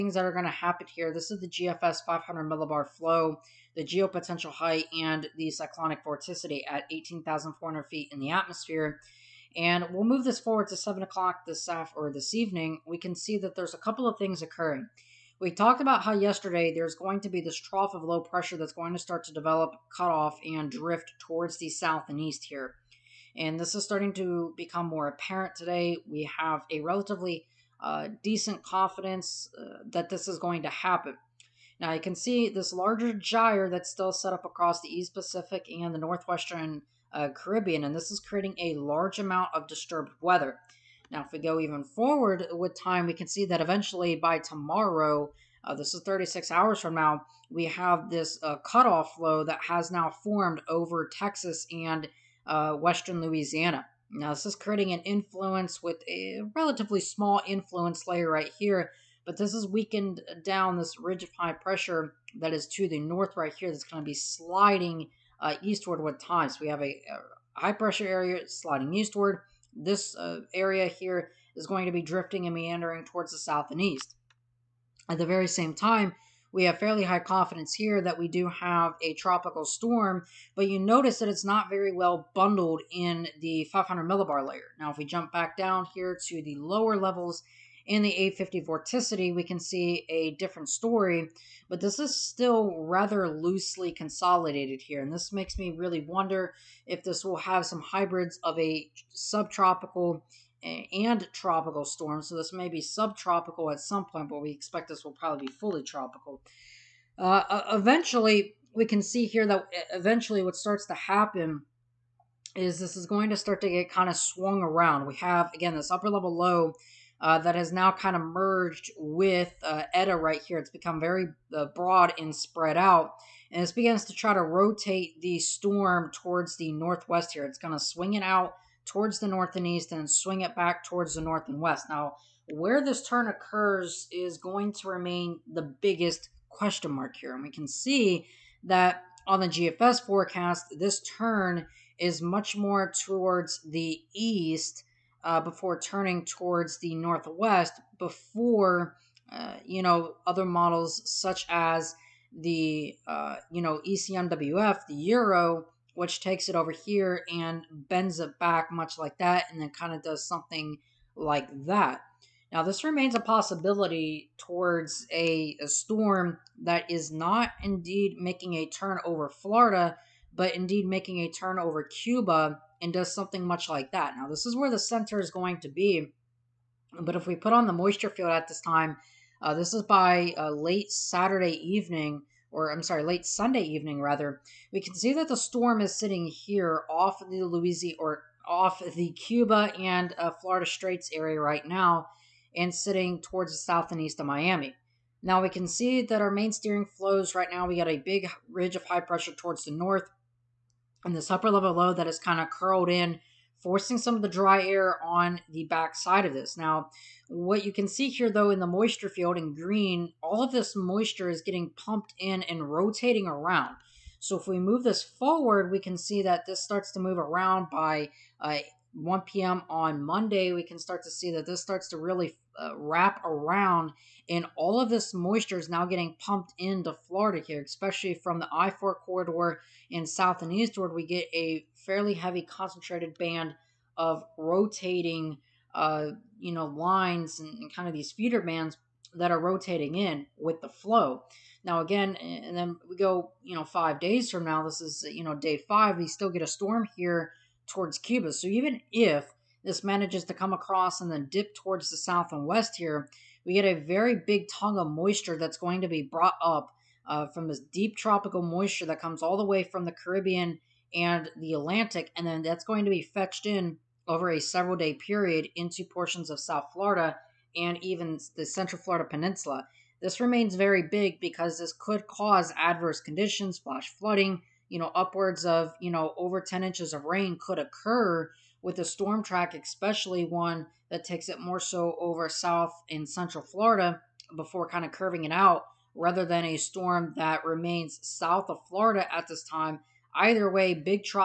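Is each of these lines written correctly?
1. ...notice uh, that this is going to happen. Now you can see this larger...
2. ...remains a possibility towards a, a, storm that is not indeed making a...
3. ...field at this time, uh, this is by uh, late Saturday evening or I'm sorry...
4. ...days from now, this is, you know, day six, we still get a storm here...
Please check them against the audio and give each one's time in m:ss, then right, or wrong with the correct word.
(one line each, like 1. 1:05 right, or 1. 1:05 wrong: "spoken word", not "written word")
1. 0:28 wrong: "confidence", not "notice"
2. 2:42 right
3. 2:58 right
4. 4:03 wrong: "five", not "six".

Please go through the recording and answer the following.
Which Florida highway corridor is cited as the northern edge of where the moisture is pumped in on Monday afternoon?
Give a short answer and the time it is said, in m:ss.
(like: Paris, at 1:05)
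I-4, at 3:48.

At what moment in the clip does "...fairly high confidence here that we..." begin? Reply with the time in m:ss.
1:16.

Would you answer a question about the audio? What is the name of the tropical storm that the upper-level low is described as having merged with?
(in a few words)
Eta.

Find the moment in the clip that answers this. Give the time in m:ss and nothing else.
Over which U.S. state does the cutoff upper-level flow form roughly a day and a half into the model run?
0:51.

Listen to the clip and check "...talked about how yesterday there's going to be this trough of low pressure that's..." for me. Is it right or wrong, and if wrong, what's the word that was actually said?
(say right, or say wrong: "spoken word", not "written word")
right.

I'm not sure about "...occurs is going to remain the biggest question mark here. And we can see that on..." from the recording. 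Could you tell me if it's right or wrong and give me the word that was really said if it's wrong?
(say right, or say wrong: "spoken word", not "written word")
right.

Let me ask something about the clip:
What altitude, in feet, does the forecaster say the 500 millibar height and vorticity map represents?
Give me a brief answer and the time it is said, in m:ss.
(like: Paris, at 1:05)
18,400 feet, at 0:06.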